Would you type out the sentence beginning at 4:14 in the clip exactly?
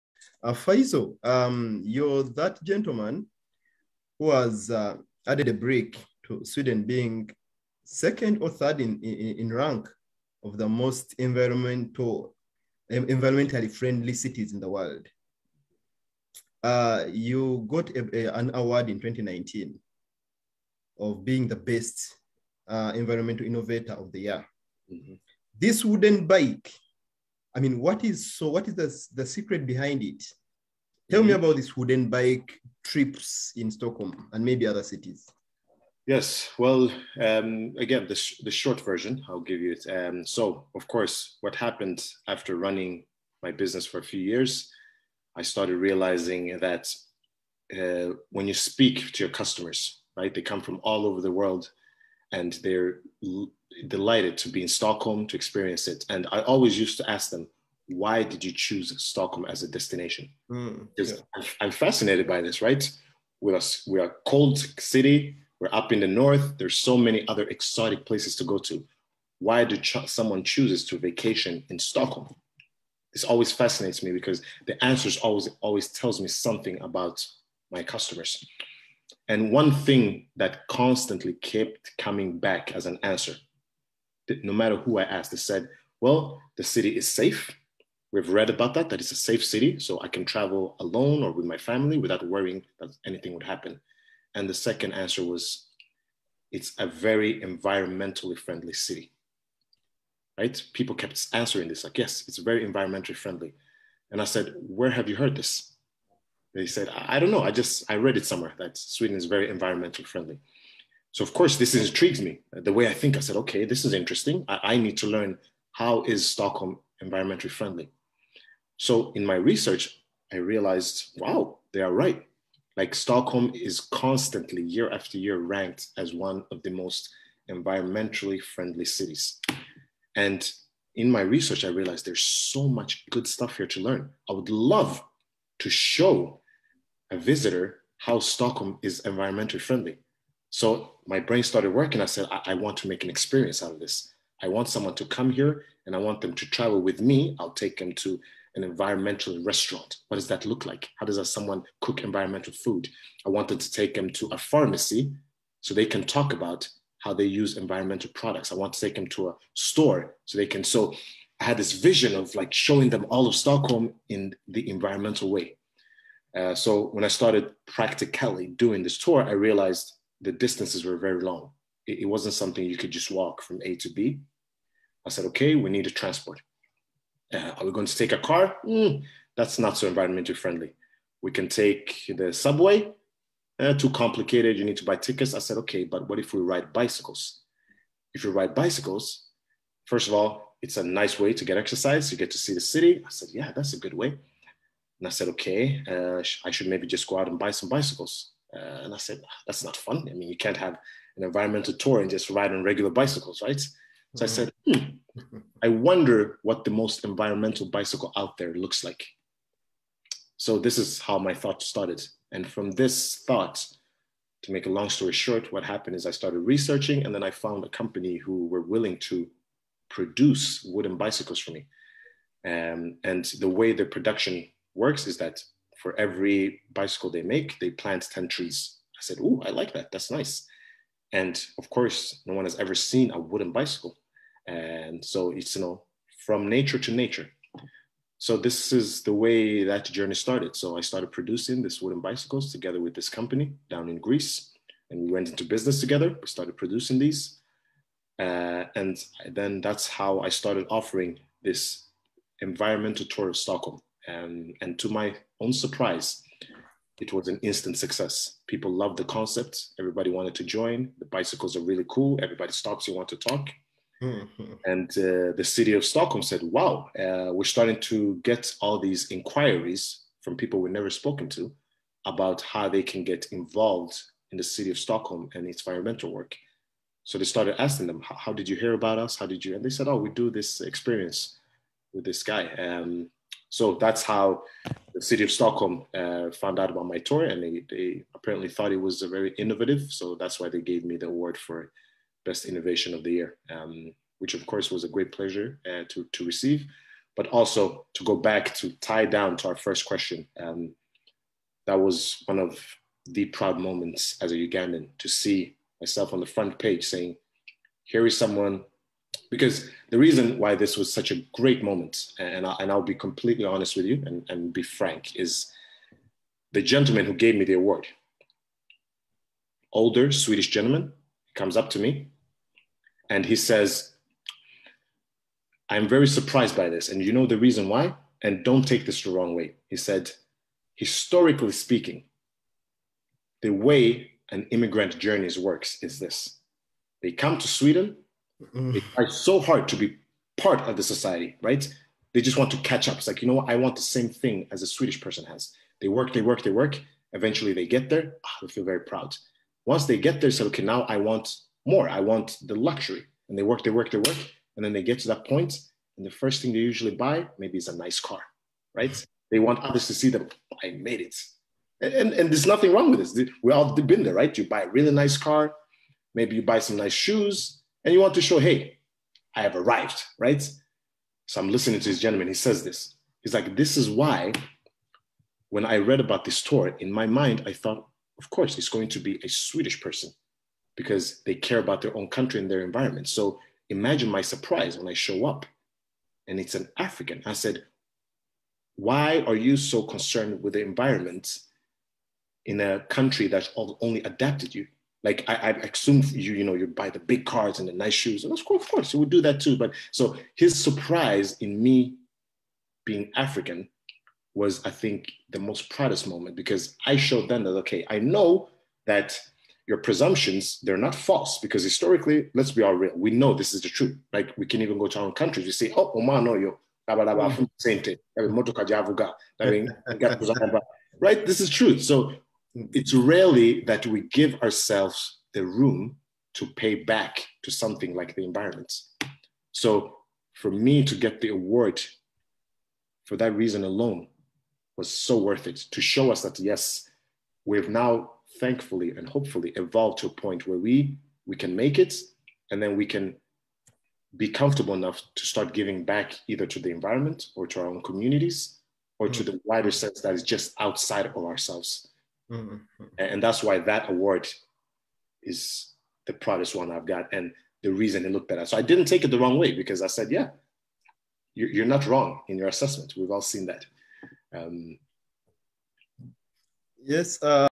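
Um, and to my own surprise, it was an instant success.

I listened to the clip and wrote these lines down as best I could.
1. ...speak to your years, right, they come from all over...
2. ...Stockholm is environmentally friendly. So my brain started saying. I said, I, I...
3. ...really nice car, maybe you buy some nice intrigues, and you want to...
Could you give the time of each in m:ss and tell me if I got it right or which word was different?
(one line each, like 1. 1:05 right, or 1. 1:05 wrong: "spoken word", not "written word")
1. 0:48 wrong: "customers", not "years"
2. 2:18 wrong: "working", not "saying"
3. 6:04 wrong: "shoes", not "intrigues".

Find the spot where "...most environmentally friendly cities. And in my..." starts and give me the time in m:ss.
2:06.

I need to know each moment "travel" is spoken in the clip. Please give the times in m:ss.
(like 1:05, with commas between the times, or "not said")
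1:30, 2:26.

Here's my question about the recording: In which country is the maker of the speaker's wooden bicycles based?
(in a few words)
Greece.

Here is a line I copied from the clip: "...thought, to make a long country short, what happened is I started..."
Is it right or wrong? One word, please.
wrong.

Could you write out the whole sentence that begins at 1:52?
The way I think, I said, okay, this is interesting.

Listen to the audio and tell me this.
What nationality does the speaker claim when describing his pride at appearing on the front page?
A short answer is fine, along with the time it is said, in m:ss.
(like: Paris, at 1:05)
Ugandan, at 5:04.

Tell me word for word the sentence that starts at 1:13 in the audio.
This always fascinates me because the answers always always tells me something about my customers.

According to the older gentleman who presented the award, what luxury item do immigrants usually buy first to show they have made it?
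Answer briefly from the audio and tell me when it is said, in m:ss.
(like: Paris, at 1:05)
A nice car, at 5:57.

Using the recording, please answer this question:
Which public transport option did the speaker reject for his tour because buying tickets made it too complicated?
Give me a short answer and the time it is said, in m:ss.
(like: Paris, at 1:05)
The subway, at 3:02.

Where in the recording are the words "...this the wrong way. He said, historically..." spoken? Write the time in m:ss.
5:28.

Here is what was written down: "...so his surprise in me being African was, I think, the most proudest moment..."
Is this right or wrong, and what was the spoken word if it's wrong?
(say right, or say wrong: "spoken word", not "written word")
right.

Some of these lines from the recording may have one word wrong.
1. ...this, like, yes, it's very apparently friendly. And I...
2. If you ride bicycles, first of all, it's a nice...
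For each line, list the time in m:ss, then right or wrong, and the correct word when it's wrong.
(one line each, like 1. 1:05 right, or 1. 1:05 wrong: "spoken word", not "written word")
1. 1:41 wrong: "environmentally", not "apparently"
2. 3:08 right.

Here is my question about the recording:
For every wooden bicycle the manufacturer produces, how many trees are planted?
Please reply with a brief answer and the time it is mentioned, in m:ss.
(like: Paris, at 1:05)
10, at 3:48.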